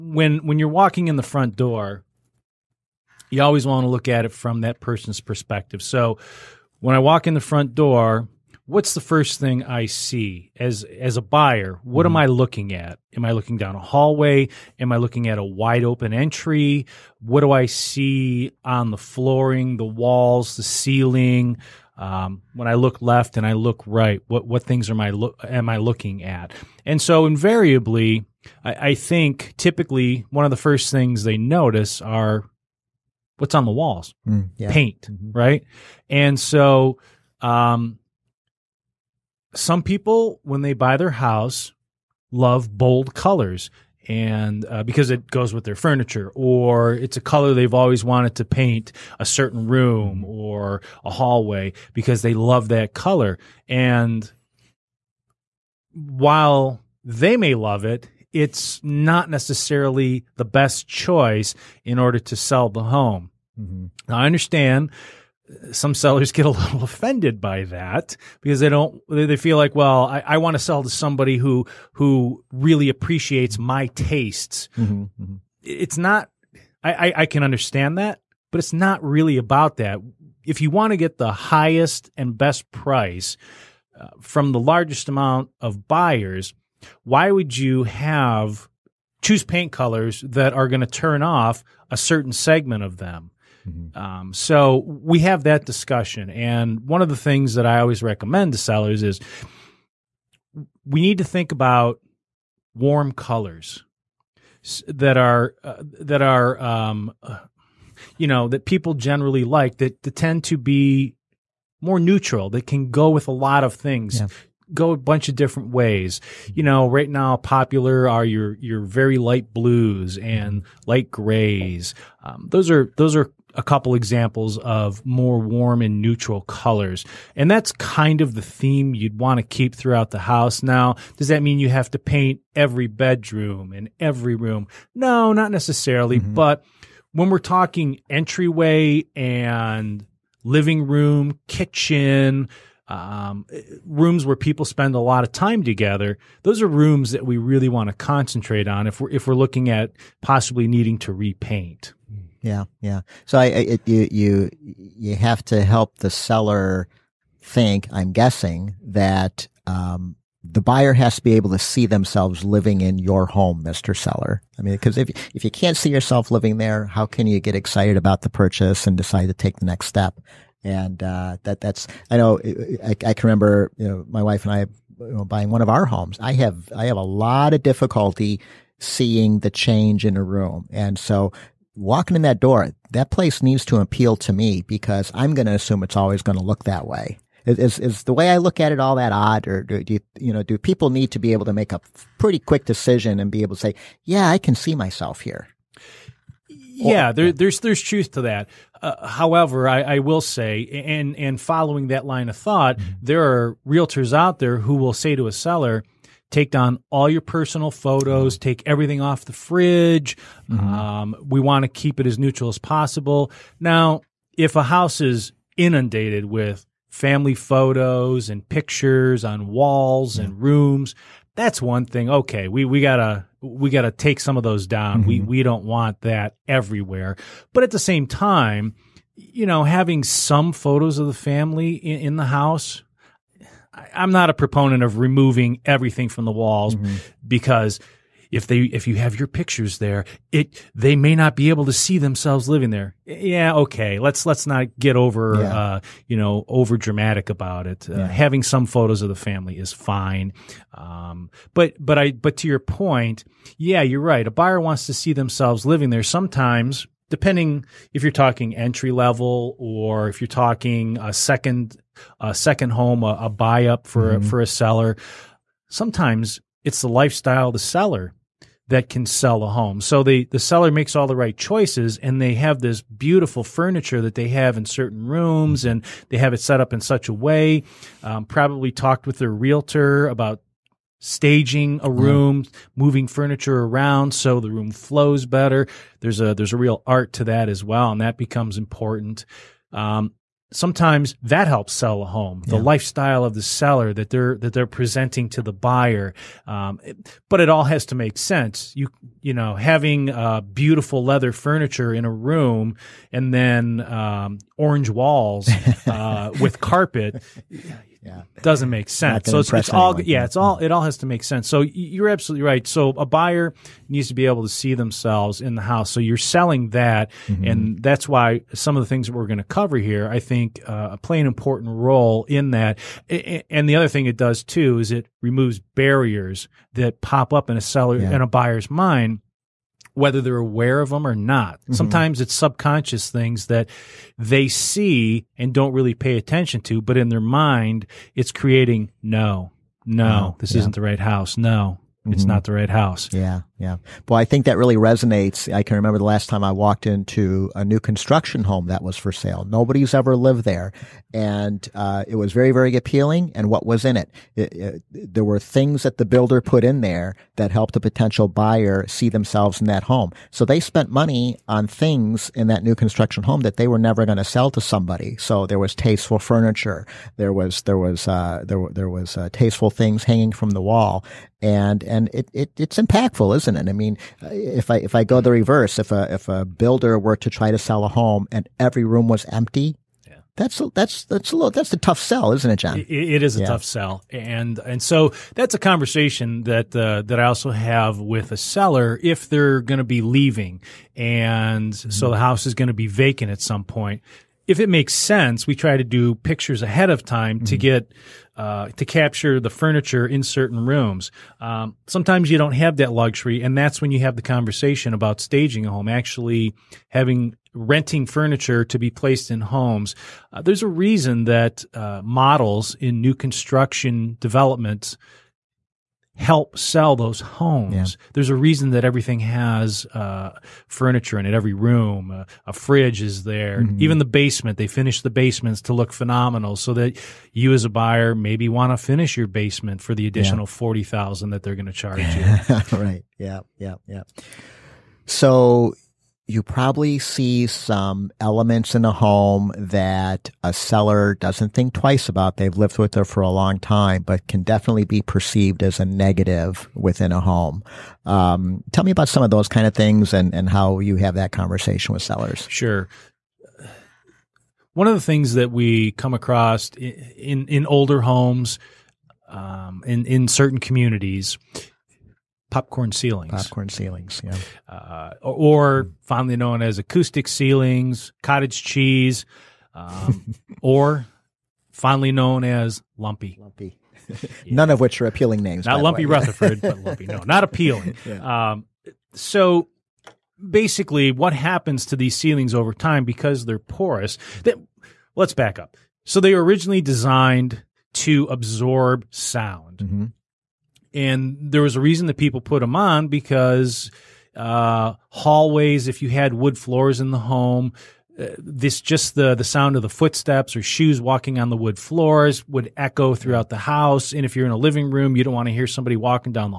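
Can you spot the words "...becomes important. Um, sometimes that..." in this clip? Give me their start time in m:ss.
4:48.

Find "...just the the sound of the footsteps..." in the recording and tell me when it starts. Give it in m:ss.
8:18.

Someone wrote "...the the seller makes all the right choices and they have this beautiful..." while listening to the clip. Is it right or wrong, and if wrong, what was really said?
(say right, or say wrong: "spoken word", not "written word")
right.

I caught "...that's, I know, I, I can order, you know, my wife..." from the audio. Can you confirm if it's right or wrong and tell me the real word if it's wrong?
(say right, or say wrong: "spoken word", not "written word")
wrong: "remember", not "order".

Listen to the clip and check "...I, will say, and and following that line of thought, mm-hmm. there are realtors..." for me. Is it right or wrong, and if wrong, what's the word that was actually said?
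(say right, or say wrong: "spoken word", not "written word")
right.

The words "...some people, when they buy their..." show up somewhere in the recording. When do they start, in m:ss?
0:39.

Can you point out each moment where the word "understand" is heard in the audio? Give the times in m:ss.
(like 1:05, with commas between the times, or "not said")
1:04, 1:17.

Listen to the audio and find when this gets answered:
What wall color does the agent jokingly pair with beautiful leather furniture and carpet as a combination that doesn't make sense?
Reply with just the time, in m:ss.
5:04.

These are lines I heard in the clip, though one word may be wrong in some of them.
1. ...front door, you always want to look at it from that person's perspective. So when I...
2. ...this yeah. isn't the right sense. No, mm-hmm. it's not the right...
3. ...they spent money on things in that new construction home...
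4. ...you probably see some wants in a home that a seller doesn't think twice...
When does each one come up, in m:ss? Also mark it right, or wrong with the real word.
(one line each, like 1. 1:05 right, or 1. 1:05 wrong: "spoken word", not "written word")
1. 0:01 right
2. 5:40 wrong: "house", not "sense"
3. 6:00 right
4. 7:16 wrong: "elements", not "wants".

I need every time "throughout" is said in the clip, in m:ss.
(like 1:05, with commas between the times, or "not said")
2:09, 8:23.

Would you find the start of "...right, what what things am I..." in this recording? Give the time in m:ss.
0:23.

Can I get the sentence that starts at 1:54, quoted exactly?
go a bunch of different ways mm-hmm.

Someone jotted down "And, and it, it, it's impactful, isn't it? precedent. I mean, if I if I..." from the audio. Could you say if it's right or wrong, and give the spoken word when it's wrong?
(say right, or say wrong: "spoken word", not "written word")
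right.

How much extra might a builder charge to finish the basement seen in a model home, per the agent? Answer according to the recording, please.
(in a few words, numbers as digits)
$40,000.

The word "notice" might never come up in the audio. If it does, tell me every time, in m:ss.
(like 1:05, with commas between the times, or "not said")
0:31.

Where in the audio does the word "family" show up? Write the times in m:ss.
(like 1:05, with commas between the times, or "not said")
3:36, 3:51, 4:09.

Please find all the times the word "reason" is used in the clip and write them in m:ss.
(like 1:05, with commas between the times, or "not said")
6:50, 6:58, 8:11.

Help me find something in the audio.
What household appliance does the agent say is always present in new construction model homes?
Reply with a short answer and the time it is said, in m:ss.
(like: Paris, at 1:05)
a fridge, at 7:02.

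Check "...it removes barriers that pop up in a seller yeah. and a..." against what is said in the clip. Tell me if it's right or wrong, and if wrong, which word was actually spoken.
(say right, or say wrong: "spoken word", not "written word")
right.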